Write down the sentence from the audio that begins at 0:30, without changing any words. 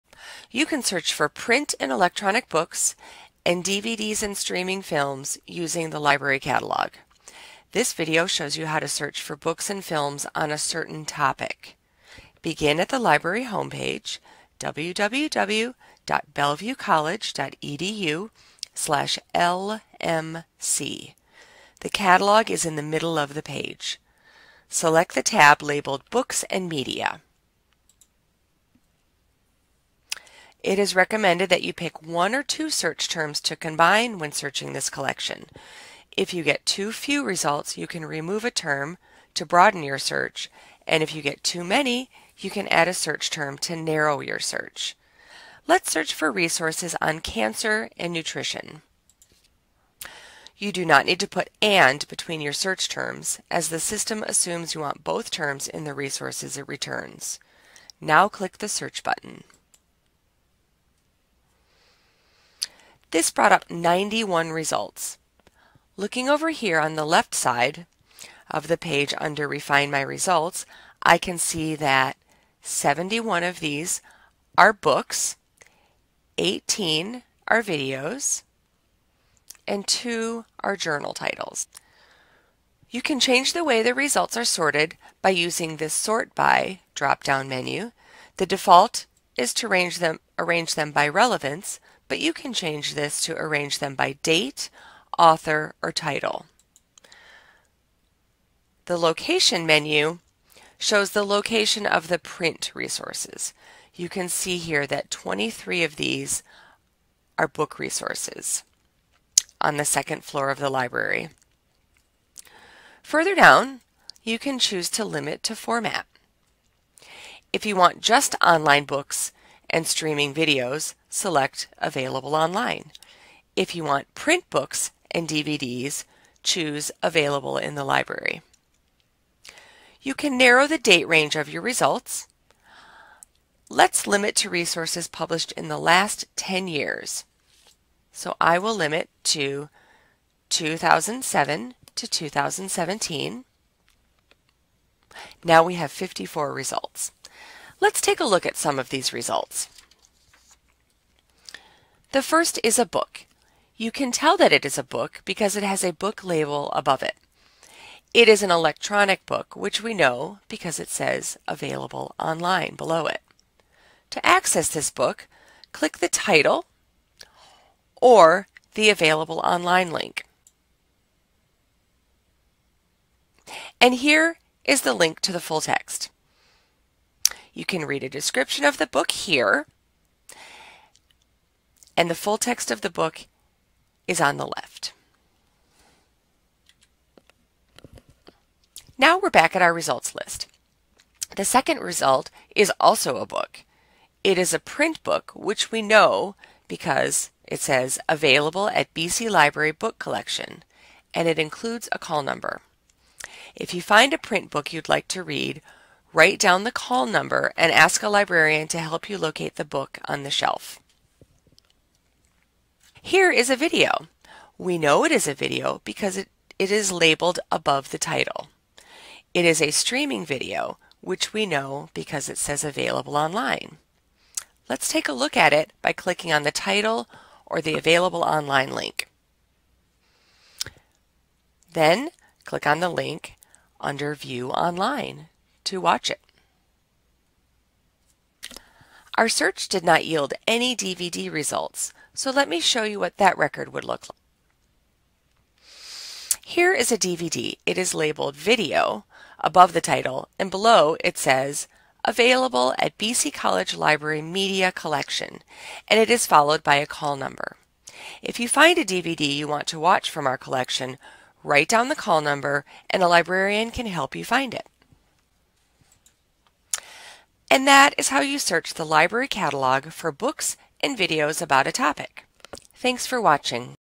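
It is recommended that you pick one or two search terms to combine when searching this collection.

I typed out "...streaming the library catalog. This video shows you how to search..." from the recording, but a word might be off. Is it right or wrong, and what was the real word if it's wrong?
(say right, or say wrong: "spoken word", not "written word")
wrong: "using", not "streaming".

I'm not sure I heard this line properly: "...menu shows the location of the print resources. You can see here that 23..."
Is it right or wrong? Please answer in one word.
right.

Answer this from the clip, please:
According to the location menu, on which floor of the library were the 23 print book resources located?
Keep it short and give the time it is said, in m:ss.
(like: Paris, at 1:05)
Second floor, at 1:49.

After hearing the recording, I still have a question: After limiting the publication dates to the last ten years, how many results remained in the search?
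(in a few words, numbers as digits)
54.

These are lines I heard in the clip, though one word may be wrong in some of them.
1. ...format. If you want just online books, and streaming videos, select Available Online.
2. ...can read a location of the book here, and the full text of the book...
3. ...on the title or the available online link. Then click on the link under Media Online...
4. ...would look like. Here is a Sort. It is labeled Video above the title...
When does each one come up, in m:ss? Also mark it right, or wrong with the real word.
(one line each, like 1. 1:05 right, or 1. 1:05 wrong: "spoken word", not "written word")
1. 1:55 right
2. 2:57 wrong: "description", not "location"
3. 3:46 wrong: "View", not "Media"
4. 4:03 wrong: "DVD", not "Sort".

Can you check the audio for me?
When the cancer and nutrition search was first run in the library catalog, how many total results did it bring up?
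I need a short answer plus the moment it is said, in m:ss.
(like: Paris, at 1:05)
91, at 1:03.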